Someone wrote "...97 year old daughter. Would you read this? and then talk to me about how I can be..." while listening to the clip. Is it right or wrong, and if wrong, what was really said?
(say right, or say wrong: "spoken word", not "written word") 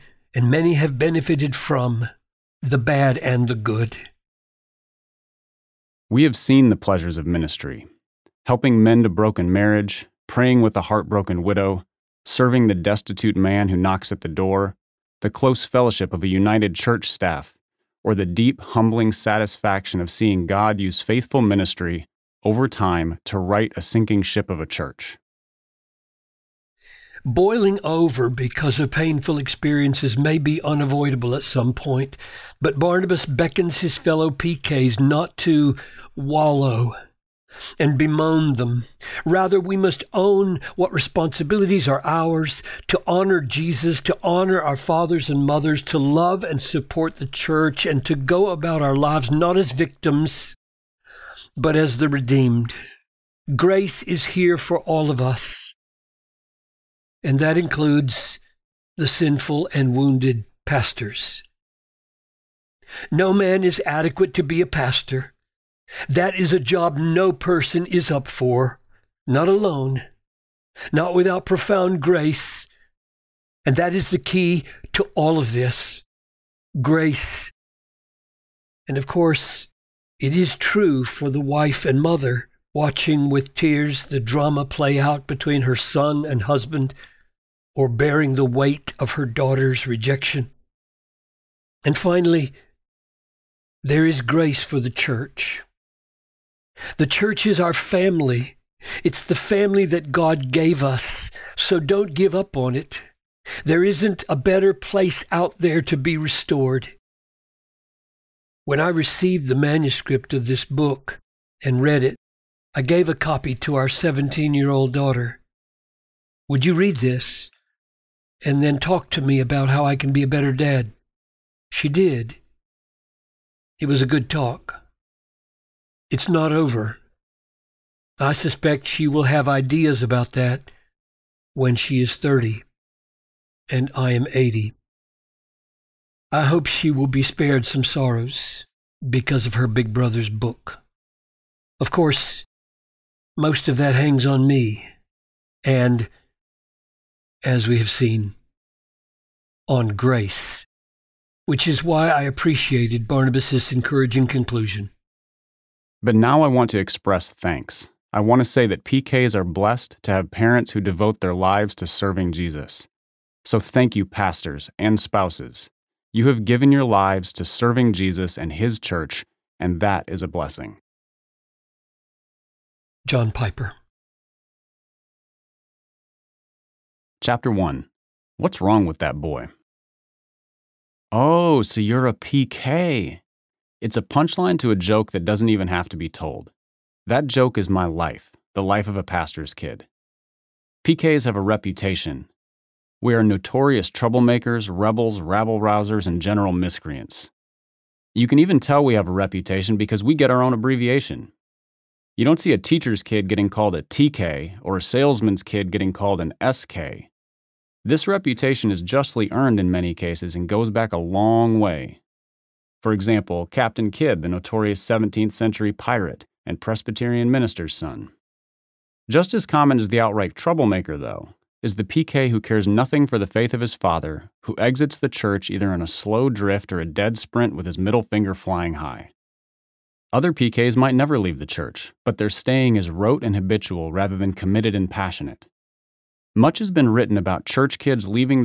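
wrong: "17", not "97".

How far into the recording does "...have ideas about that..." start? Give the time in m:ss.
2:09.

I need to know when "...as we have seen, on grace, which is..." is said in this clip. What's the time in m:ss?
2:27.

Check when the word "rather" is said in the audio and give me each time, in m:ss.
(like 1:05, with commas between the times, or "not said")
0:39, 3:53.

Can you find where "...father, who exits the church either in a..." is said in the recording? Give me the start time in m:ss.
3:43.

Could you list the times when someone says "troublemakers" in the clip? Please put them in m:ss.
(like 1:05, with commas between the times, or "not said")
3:13, 3:40.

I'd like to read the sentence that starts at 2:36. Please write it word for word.
But now I want to express thanks.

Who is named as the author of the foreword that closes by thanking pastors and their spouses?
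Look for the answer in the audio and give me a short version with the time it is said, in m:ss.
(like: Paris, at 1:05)
John Piper, at 2:53.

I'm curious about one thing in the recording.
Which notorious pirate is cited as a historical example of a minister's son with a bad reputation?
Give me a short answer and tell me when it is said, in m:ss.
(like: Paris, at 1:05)
Captain Kidd, at 3:33.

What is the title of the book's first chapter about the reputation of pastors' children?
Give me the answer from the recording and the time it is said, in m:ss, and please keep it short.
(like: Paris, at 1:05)
What's Wrong with That Boy?, at 2:58.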